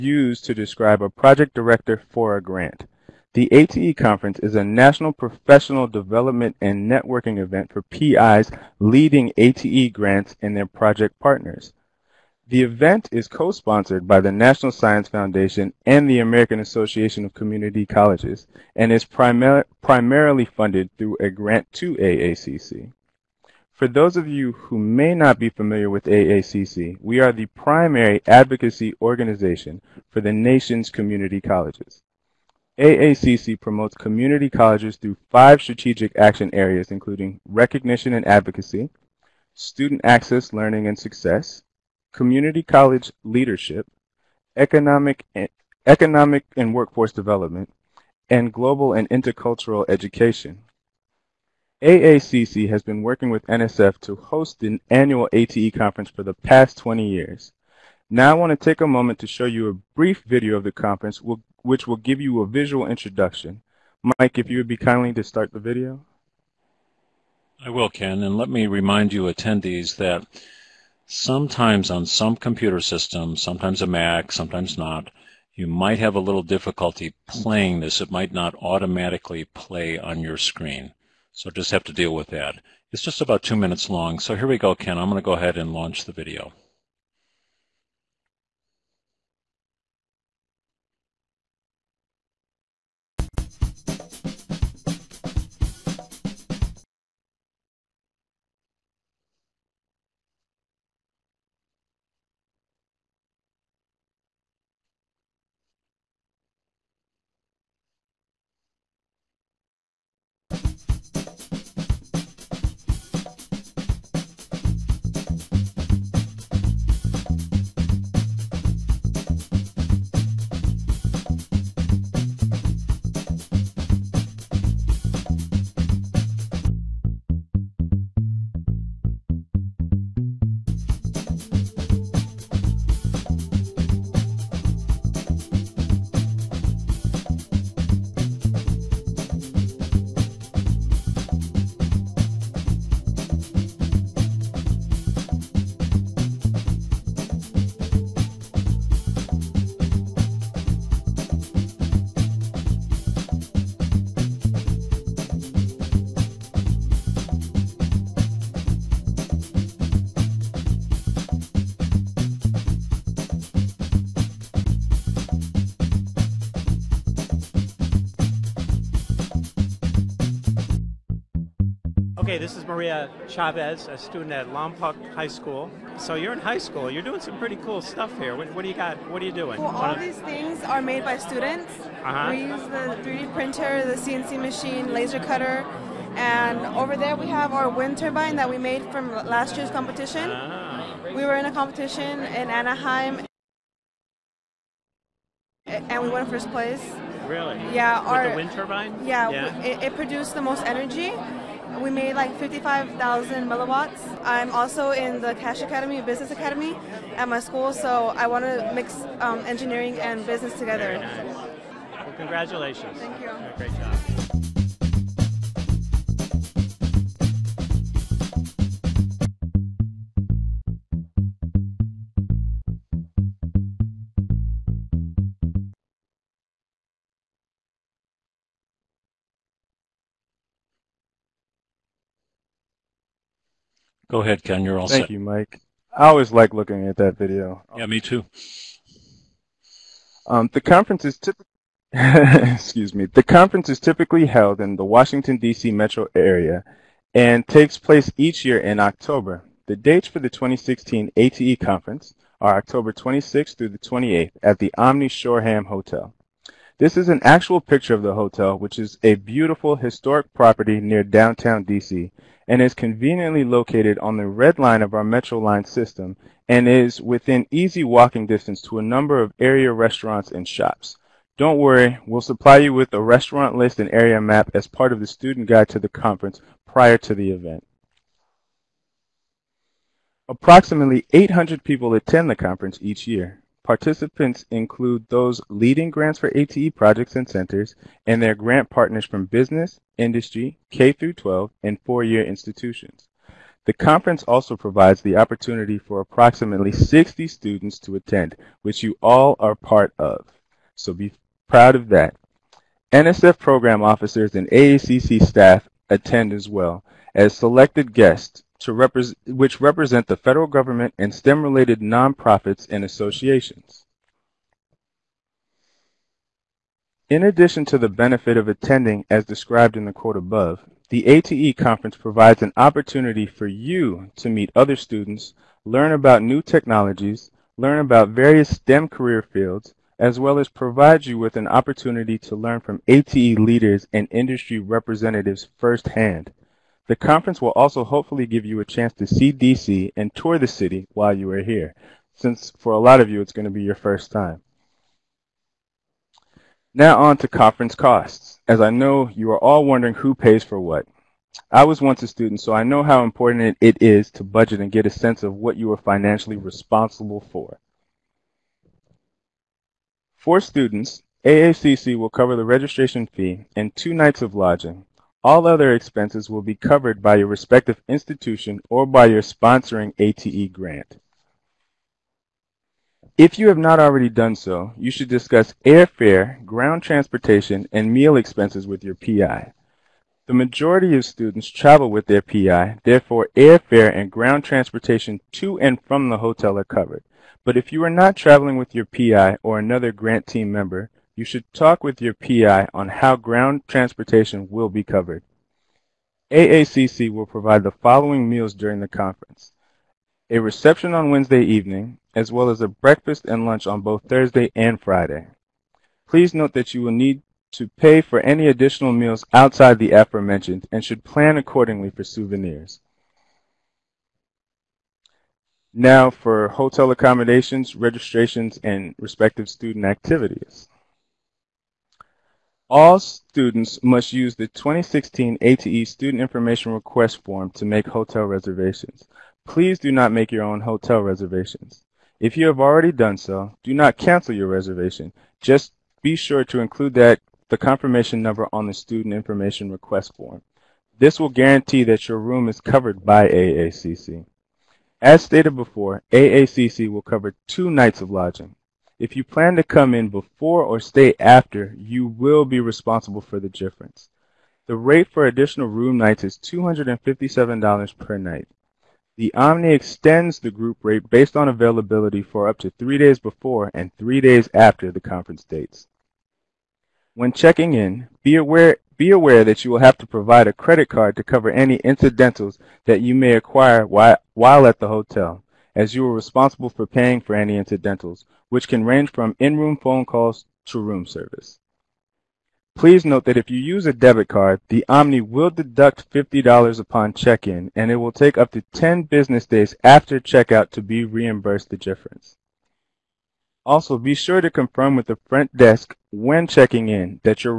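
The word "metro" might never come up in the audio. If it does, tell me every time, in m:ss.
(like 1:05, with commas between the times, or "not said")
4:05, 4:25.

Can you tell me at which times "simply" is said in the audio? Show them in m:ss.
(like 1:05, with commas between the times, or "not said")
not said.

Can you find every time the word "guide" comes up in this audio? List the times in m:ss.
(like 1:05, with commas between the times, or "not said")
4:35.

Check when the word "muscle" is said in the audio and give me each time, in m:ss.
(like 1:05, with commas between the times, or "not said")
not said.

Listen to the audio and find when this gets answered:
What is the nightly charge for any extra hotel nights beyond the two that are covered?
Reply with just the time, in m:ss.
7:36.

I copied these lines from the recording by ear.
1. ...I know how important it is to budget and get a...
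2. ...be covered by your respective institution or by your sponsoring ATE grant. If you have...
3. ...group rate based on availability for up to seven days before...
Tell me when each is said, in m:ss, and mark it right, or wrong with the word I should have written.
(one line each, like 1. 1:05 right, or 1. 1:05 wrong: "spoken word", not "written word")
1. 5:52 right
2. 6:06 right
3. 7:40 wrong: "three", not "seven".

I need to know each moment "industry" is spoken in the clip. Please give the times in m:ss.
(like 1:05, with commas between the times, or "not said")
4:49, 5:34.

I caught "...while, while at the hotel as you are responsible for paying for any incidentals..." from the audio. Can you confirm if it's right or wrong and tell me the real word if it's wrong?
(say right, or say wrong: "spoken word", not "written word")
right.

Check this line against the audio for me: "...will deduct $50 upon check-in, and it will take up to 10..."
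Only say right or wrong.
right.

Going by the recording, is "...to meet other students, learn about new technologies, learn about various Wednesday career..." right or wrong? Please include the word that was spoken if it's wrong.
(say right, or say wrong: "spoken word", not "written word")
wrong: "STEM", not "Wednesday".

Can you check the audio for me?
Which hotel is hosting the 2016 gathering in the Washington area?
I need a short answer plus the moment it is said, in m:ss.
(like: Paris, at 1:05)
Omni Shoreham Hotel, at 4:14.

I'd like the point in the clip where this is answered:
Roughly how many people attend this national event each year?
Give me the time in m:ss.
4:41.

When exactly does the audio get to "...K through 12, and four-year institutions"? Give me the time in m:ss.
4:50.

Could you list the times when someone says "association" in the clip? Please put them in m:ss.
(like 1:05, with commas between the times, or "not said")
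0:16, 5:12.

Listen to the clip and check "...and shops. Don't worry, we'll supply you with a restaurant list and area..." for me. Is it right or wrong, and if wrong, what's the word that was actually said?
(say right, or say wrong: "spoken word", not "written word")
right.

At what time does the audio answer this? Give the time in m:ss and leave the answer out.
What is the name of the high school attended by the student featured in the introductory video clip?
2:54.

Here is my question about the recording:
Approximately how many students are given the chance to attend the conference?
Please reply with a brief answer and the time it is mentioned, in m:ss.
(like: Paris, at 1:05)
60, at 4:56.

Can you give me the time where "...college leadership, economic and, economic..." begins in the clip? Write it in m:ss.
0:42.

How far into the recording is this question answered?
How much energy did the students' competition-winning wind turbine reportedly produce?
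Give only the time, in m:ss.
3:22.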